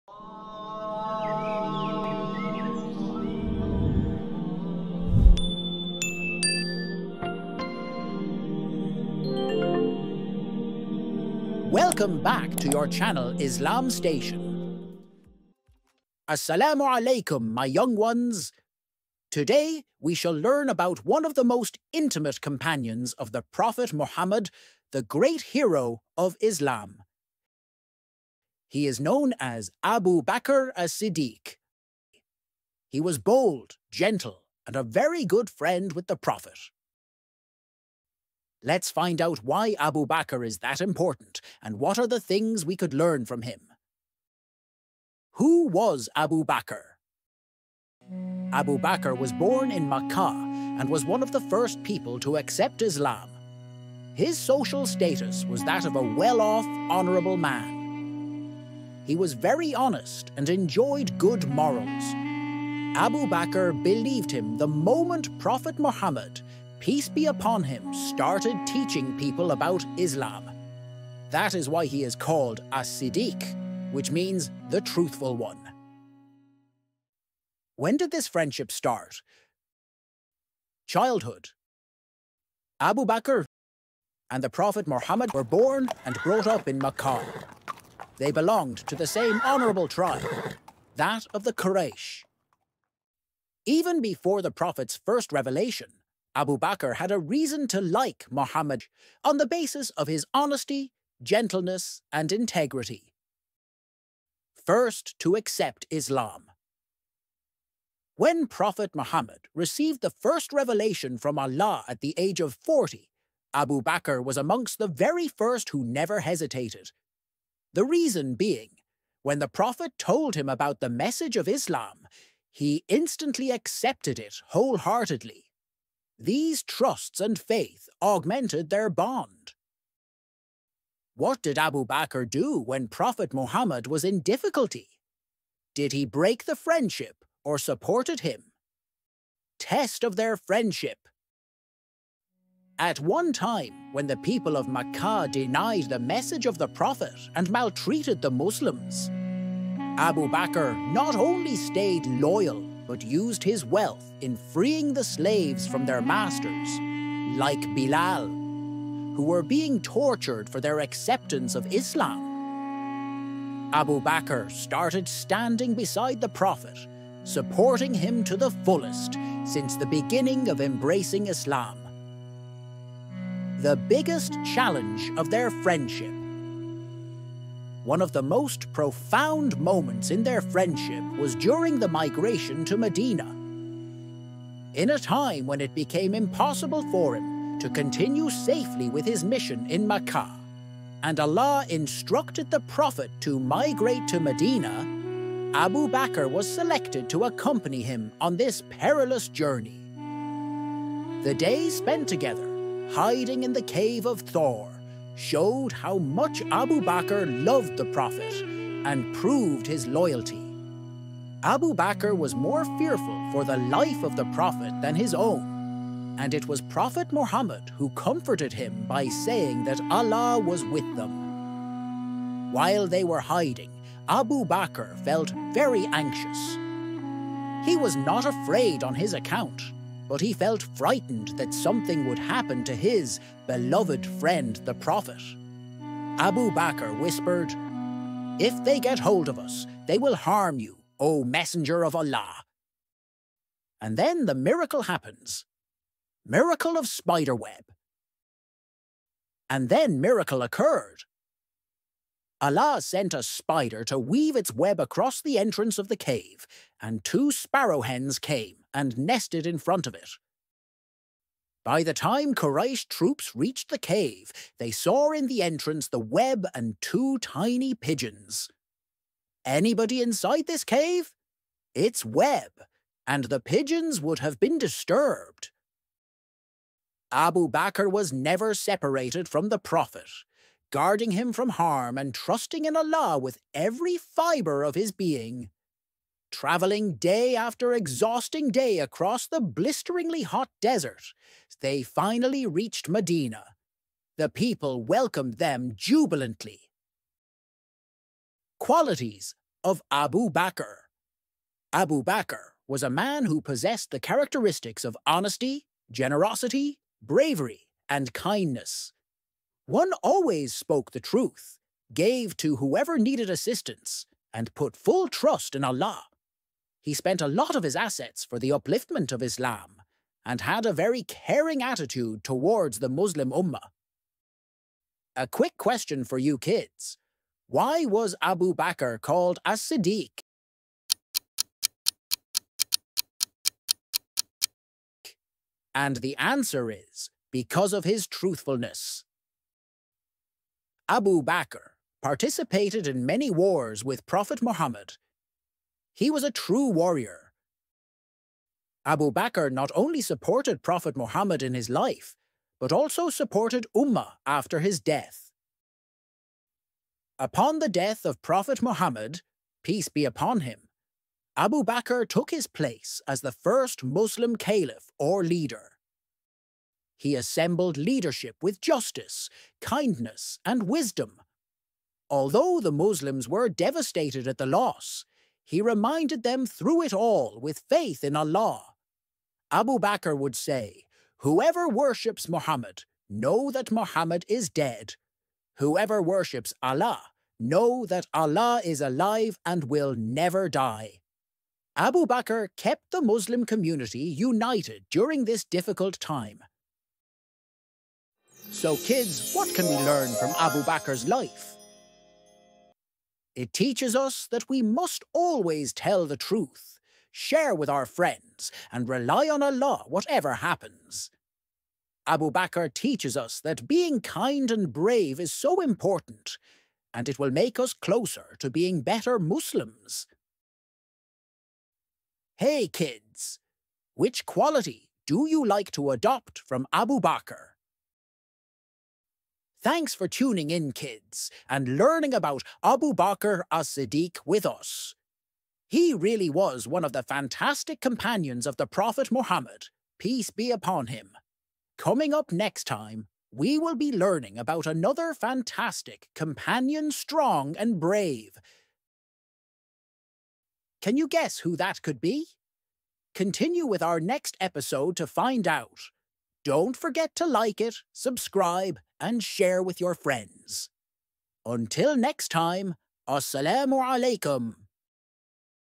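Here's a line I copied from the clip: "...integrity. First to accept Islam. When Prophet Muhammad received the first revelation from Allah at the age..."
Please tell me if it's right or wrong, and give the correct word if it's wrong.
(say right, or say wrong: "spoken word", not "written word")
right.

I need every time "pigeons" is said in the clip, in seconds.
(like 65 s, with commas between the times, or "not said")
267 s, 273 s.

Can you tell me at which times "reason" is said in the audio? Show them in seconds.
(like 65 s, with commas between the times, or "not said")
97 s, 117 s.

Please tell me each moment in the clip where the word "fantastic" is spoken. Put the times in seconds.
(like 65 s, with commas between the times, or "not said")
437 s, 445 s.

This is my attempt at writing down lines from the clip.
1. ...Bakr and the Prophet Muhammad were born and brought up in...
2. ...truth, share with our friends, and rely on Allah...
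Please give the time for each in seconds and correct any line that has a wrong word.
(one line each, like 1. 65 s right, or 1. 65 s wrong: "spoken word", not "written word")
1. 83 s right
2. 406 s right.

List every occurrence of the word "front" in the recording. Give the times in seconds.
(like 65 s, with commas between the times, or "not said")
259 s.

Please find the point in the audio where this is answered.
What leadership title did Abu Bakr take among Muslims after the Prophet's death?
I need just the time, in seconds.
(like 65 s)
363 s.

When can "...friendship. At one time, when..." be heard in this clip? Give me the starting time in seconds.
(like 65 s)
140 s.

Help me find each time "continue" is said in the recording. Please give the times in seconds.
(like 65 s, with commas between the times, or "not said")
187 s, 453 s.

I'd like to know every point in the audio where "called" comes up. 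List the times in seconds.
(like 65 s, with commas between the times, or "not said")
72 s, 328 s.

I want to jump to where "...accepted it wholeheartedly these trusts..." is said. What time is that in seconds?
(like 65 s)
123 s.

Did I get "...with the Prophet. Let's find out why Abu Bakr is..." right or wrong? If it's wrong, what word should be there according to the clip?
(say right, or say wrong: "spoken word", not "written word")
right.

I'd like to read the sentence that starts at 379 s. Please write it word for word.
Abu Bakr would say, Whoever worships Muhammad, know that Muhammad is dead.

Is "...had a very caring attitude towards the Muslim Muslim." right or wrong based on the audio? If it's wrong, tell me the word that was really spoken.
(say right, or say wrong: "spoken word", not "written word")
wrong: "Ummah", not "Muslim".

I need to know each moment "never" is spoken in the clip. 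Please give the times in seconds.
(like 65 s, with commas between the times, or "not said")
115 s, 278 s, 389 s.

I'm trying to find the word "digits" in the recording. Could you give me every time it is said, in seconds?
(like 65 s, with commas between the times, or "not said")
not said.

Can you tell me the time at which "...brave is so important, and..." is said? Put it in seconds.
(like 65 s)
414 s.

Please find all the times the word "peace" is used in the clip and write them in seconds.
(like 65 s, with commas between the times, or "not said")
66 s, 359 s, 439 s.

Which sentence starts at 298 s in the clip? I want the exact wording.
Qualities of Abu Bakr Abu Bakr was a man who possessed the characteristics of honesty, generosity, bravery, and kindness.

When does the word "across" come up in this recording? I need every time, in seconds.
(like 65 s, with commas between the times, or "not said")
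254 s, 288 s.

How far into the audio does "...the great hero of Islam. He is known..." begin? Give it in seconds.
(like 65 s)
24 s.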